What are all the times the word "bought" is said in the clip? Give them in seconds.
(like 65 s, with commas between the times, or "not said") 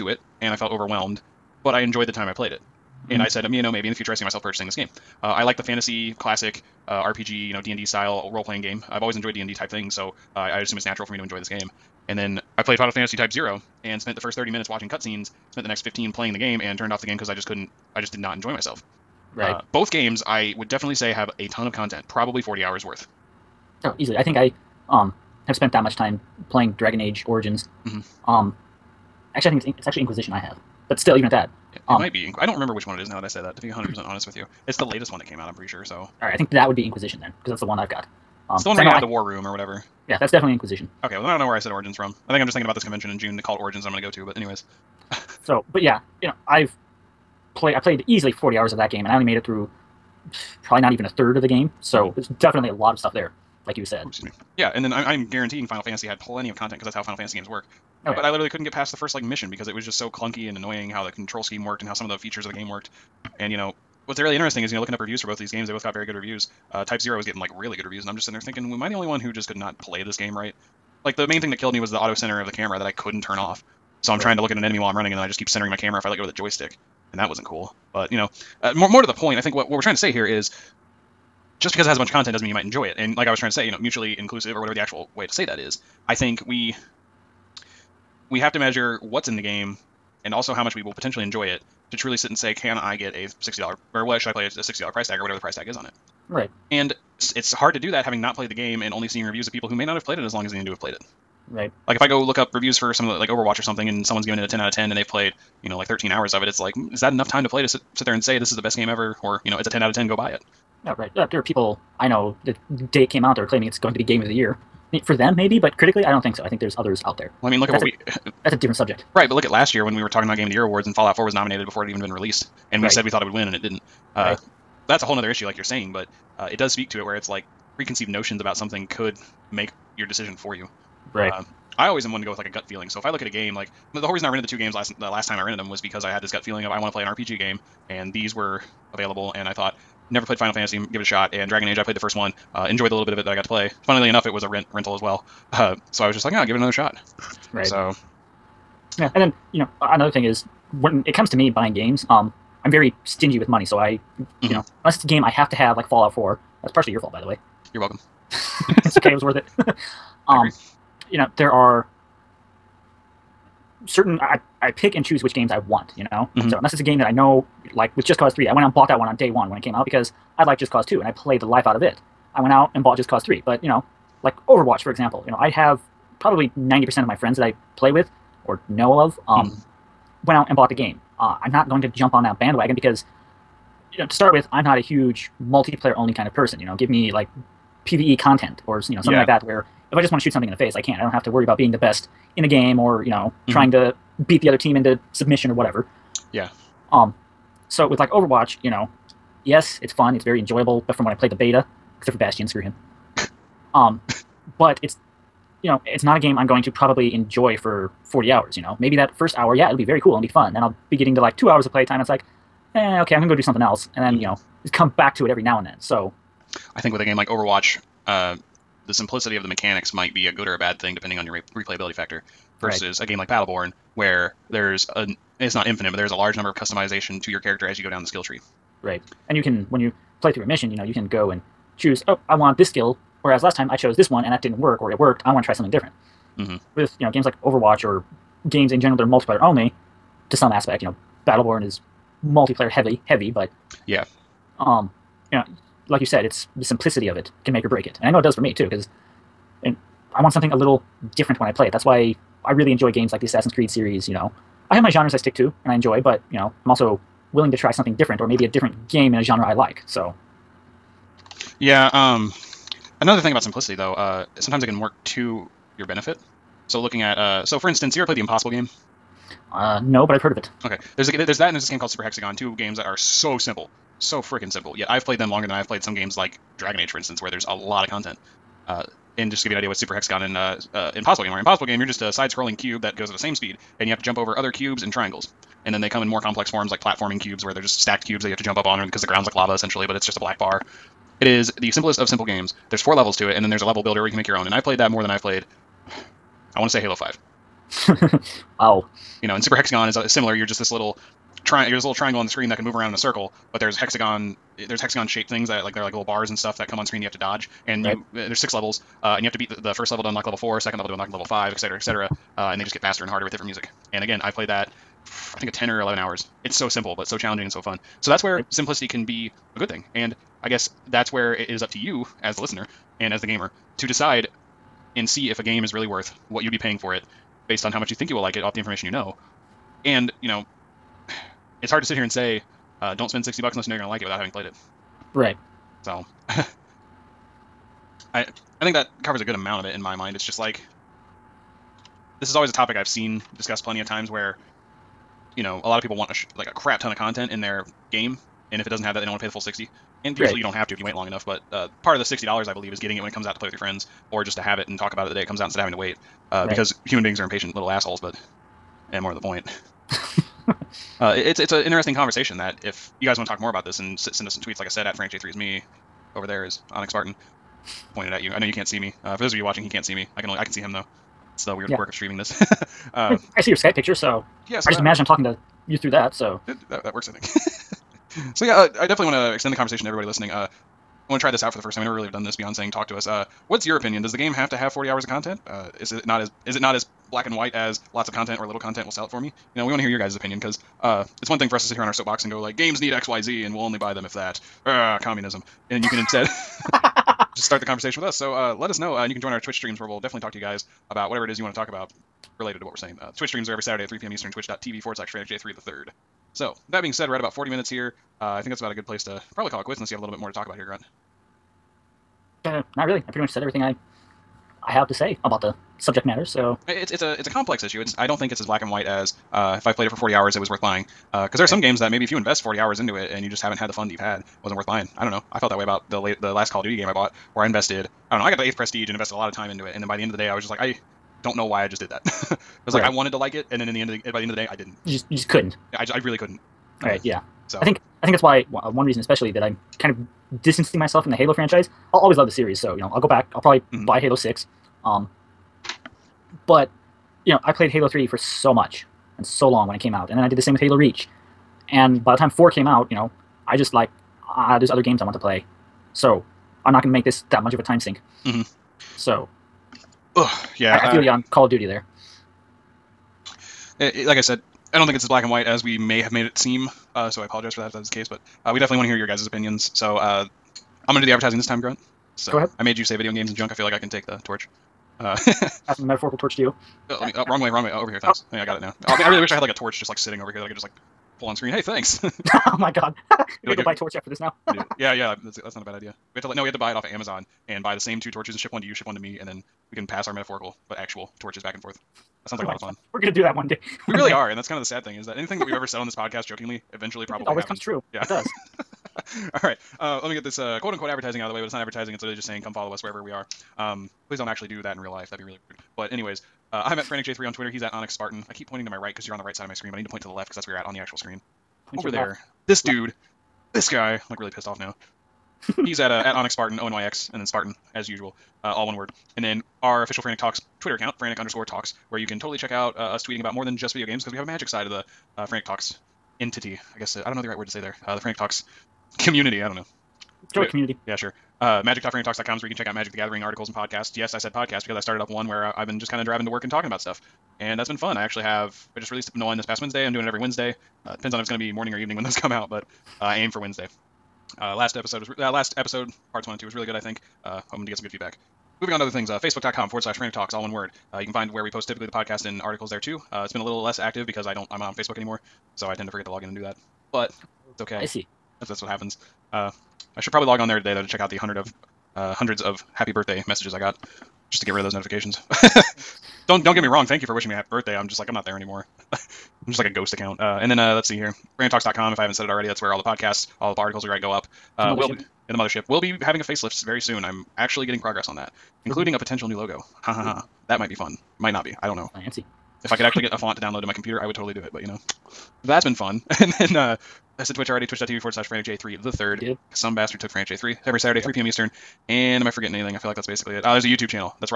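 168 s, 172 s, 180 s, 426 s.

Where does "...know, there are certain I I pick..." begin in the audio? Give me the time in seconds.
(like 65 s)
161 s.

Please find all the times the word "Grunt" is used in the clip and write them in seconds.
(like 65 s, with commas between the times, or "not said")
410 s, 471 s.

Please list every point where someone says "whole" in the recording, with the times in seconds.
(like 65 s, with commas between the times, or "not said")
125 s, 134 s.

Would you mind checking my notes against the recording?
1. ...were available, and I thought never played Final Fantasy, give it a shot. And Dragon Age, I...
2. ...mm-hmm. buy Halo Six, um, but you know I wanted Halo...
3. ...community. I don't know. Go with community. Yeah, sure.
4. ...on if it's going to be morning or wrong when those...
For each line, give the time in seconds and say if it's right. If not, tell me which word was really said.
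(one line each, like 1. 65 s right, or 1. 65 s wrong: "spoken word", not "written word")
1. 138 s right
2. 443 s wrong: "played", not "wanted"
3. 528 s right
4. 541 s wrong: "evening", not "wrong".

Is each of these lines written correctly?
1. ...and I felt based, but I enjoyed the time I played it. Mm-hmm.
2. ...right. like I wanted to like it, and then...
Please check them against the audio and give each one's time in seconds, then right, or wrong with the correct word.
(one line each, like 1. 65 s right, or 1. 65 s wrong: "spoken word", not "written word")
1. 0 s wrong: "overwhelmed", not "based"
2. 432 s right.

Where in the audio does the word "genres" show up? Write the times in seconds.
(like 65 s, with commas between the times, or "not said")
254 s, 259 s.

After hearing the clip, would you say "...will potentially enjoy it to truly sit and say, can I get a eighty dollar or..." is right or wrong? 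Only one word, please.
wrong.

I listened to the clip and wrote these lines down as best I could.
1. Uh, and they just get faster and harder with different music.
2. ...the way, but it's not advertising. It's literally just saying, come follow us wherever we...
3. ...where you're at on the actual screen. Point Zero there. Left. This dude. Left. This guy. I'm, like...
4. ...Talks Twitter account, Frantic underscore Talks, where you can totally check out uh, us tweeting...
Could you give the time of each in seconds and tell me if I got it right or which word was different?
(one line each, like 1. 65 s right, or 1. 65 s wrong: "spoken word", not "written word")
1. 312 s right
2. 501 s right
3. 510 s wrong: "Over", not "Zero"
4. 520 s right.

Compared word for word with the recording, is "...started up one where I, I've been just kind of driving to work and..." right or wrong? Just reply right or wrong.
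right.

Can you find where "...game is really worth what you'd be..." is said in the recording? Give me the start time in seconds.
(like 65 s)
325 s.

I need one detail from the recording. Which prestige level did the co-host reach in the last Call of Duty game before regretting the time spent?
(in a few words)
8th.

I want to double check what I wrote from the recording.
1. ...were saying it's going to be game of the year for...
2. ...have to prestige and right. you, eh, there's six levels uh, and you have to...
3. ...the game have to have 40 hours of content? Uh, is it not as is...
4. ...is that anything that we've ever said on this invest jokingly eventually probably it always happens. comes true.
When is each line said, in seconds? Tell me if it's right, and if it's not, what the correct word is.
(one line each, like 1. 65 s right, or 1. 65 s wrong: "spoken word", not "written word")
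1. 113 s wrong: "claiming", not "saying"
2. 307 s wrong: "dodge", not "prestige"
3. 384 s right
4. 494 s wrong: "podcast", not "invest".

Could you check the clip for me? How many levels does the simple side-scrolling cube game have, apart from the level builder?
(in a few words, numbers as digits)
4.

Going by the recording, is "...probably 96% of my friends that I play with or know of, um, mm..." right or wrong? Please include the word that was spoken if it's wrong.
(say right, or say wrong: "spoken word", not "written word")
wrong: "90", not "96".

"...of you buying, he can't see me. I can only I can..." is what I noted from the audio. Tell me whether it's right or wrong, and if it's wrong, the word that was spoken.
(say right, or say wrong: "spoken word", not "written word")
wrong: "watching", not "buying".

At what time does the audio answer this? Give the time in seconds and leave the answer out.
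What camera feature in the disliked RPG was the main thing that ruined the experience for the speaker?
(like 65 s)
71 s.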